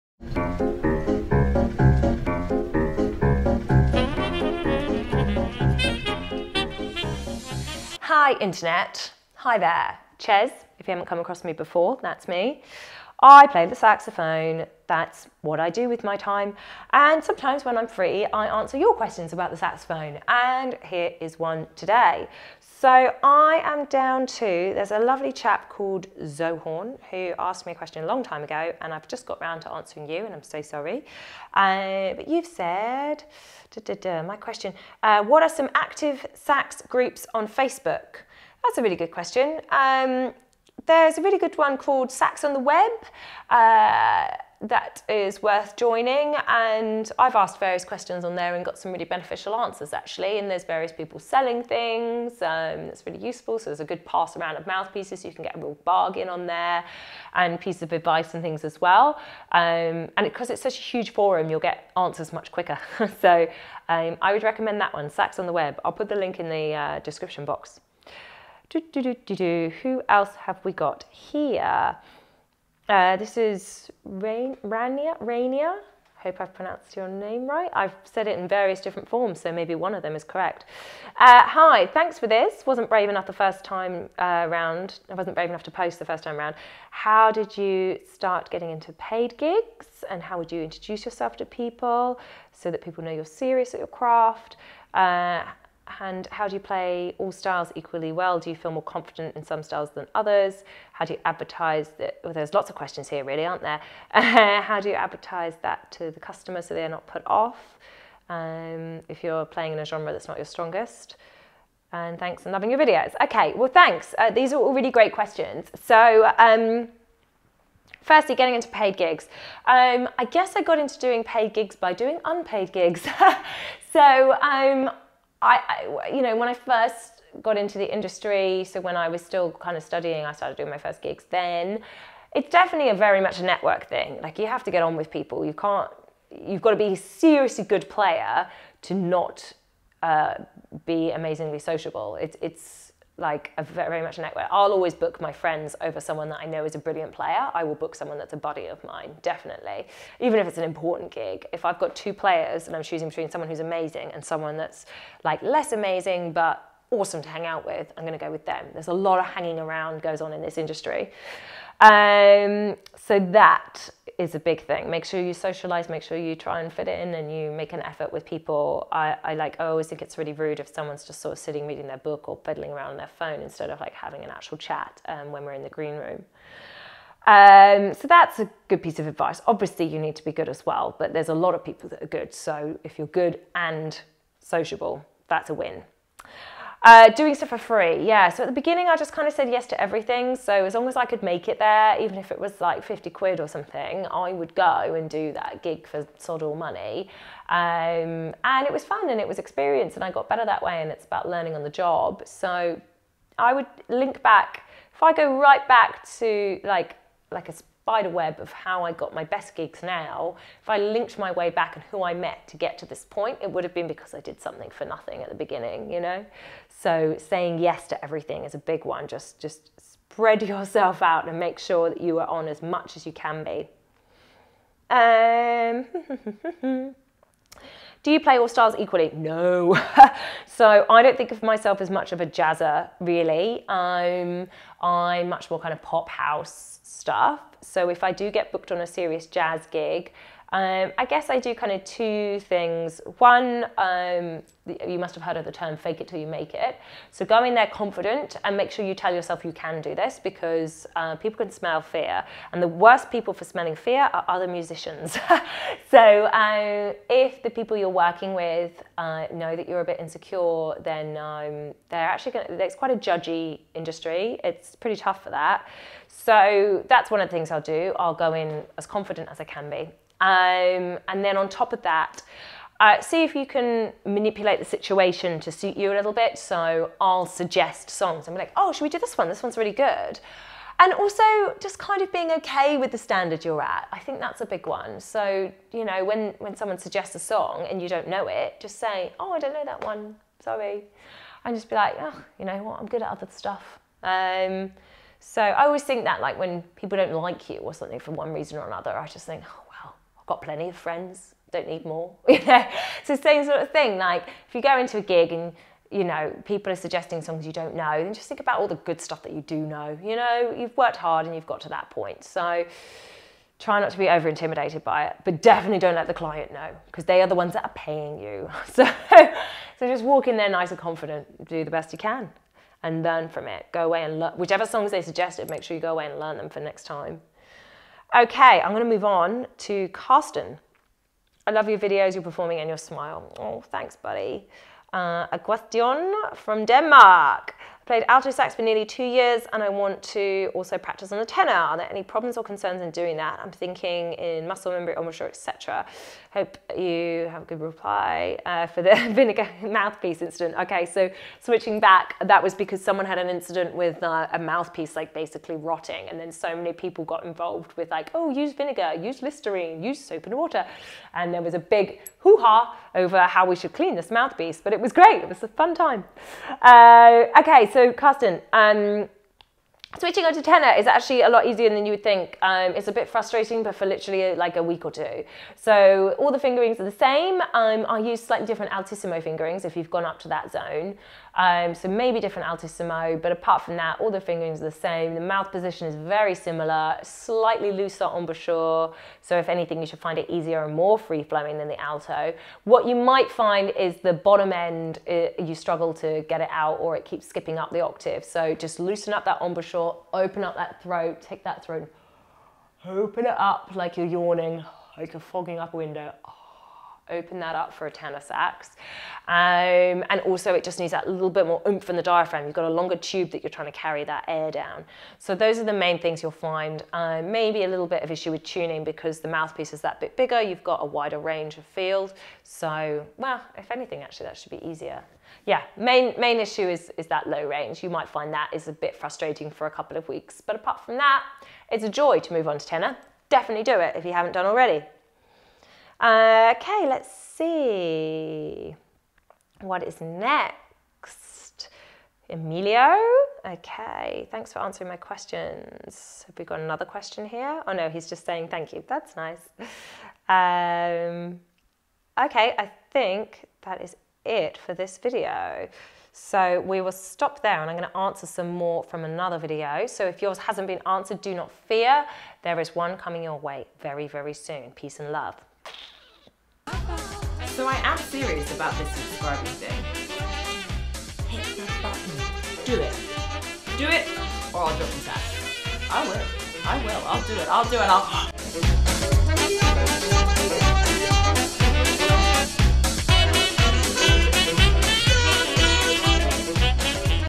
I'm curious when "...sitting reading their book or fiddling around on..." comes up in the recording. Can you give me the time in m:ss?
2:51.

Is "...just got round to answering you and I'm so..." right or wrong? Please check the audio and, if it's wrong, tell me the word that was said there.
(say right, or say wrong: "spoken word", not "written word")
right.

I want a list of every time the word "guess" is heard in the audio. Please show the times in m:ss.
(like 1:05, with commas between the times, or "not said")
2:00, 4:01.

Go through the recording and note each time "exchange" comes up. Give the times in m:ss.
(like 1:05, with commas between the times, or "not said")
not said.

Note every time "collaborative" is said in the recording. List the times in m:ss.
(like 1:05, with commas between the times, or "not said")
not said.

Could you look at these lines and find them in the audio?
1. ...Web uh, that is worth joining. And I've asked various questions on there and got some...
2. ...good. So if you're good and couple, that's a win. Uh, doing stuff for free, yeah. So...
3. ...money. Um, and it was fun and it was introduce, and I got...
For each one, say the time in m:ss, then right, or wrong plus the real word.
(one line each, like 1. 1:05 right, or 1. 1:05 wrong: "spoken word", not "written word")
1. 0:42 right
2. 3:02 wrong: "sociable", not "couple"
3. 3:16 wrong: "experience", not "introduce".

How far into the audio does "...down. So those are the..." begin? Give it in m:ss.
6:54.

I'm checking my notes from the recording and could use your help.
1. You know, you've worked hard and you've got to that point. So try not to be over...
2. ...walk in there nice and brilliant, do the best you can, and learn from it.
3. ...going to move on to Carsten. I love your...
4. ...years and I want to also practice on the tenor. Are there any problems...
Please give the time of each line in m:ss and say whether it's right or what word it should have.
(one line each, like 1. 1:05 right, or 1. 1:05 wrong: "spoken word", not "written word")
1. 5:10 right
2. 5:20 wrong: "confident", not "brilliant"
3. 5:28 right
4. 5:39 right.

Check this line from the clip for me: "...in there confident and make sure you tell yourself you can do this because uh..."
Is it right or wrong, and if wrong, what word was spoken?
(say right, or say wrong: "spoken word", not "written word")
right.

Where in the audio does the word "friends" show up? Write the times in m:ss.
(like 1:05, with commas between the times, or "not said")
2:25, 5:00.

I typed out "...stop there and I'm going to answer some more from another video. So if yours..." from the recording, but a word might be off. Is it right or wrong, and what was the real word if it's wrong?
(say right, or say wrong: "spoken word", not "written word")
right.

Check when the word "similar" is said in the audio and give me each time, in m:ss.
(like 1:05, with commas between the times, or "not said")
6:26.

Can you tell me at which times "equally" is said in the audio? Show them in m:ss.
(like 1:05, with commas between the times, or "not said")
1:37, 3:48.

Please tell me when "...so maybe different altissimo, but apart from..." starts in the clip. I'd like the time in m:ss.
6:21.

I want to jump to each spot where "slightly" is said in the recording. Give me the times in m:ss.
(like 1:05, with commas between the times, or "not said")
6:18, 6:27.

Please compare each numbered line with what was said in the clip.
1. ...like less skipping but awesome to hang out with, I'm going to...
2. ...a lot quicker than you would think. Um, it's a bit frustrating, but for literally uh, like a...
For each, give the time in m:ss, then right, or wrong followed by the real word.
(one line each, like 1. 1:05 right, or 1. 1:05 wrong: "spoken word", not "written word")
1. 2:35 wrong: "amazing", not "skipping"
2. 6:11 wrong: "easier", not "quicker".